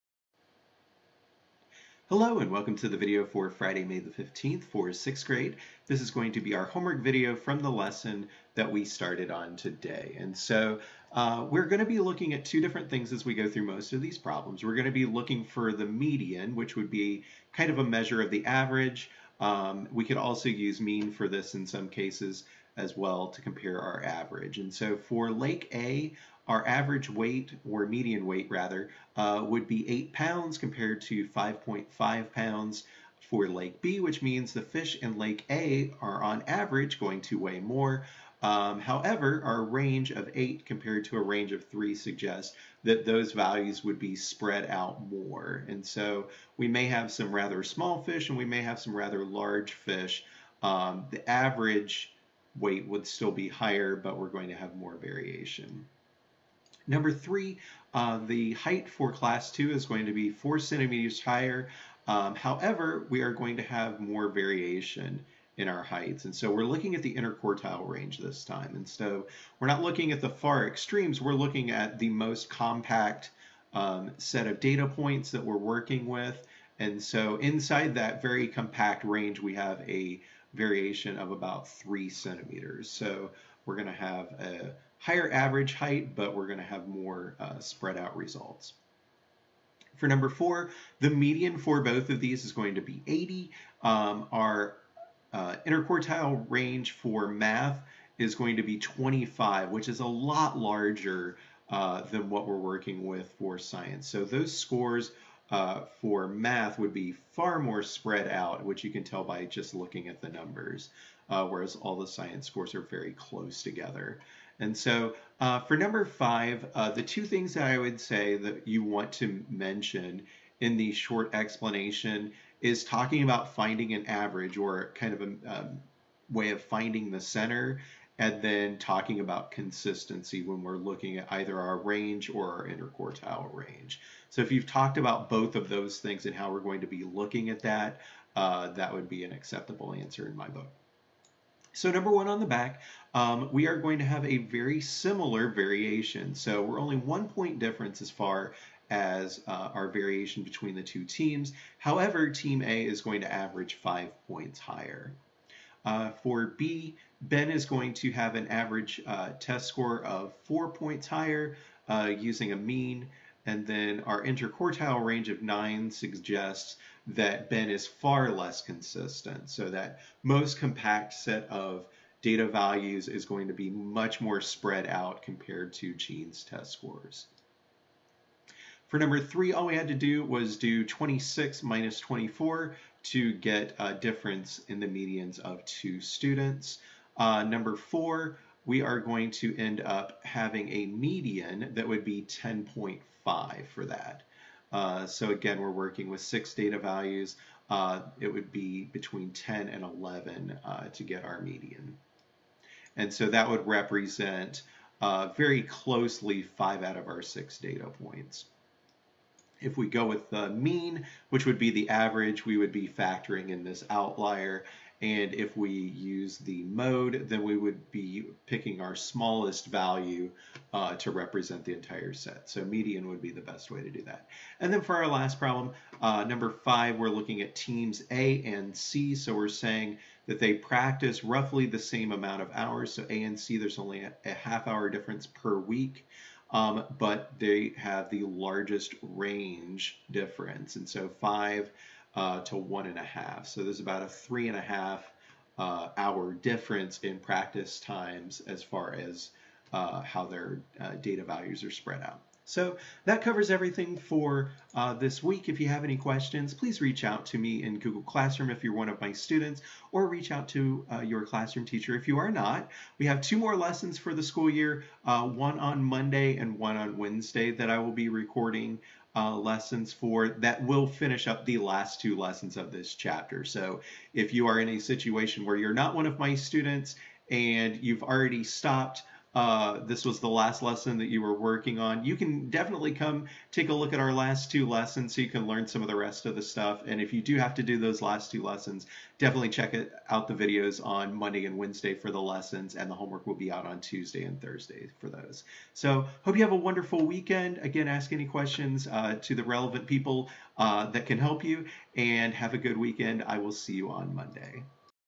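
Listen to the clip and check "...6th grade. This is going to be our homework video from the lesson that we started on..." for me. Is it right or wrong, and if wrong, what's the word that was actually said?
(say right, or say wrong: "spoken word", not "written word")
right.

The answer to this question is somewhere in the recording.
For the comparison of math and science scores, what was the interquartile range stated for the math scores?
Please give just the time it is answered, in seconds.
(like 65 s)
98 s.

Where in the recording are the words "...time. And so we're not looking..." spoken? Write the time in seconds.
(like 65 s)
68 s.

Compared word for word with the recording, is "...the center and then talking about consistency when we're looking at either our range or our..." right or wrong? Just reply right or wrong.
right.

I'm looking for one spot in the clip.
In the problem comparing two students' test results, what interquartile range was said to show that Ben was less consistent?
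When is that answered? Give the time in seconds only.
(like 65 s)
165 s.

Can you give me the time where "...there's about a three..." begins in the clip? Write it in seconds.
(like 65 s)
243 s.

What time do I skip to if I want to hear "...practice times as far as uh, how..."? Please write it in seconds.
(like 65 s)
247 s.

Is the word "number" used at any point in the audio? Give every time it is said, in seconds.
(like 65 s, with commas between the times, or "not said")
56 s, 90 s, 110 s, 115 s, 141 s, 178 s, 187 s, 226 s.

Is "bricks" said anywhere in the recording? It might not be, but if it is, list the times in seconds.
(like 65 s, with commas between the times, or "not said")
not said.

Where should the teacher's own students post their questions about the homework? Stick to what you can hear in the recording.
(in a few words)
Google Classroom.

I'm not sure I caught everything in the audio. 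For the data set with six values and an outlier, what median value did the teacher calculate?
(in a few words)
10.5.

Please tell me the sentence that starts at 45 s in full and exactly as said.
And so we may have some rather small fish and we may have some rather large fish.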